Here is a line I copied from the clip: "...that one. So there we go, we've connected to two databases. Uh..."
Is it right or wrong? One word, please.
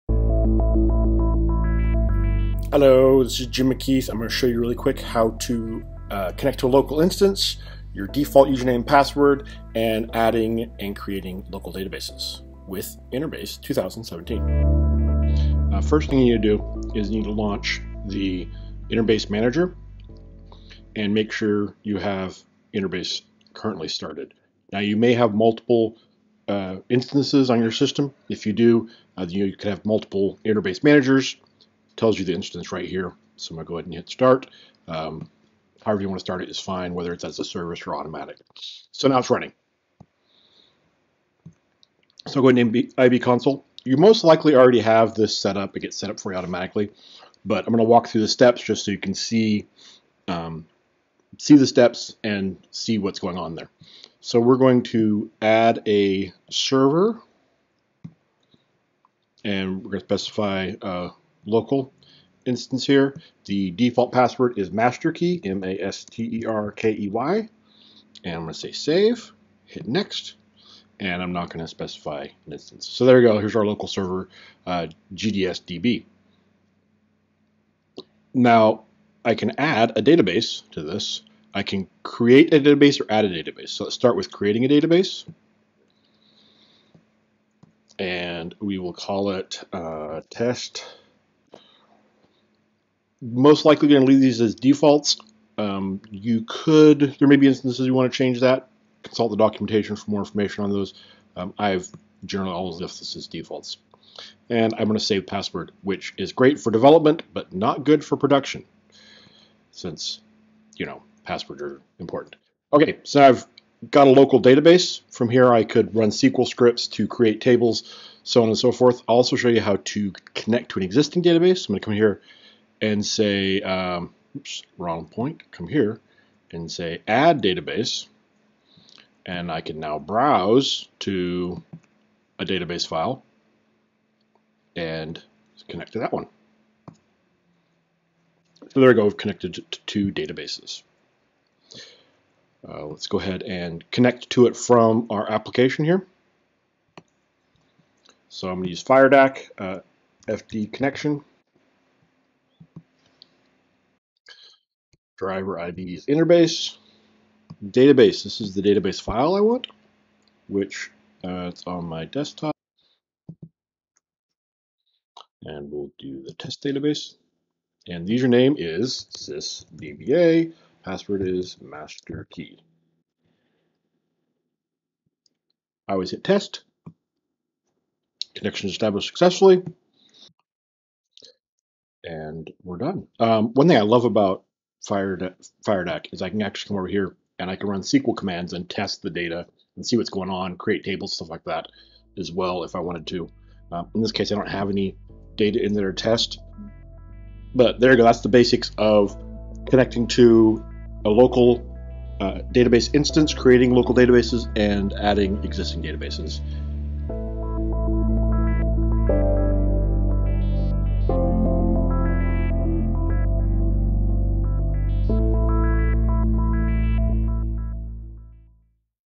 right.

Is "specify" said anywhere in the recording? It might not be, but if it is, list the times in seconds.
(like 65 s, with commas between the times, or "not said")
60 s, 71 s.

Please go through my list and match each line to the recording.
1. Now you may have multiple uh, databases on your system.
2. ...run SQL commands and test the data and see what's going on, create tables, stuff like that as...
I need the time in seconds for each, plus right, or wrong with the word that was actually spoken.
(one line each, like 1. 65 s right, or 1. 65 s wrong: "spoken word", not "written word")
1. 24 s wrong: "instances", not "databases"
2. 187 s right.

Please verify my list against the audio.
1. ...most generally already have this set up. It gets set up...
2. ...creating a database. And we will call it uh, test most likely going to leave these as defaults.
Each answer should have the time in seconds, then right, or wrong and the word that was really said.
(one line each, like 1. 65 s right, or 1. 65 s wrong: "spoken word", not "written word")
1. 43 s wrong: "likely", not "generally"
2. 84 s right.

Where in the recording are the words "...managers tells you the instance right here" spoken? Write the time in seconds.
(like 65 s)
30 s.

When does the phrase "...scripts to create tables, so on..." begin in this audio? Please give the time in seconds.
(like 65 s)
116 s.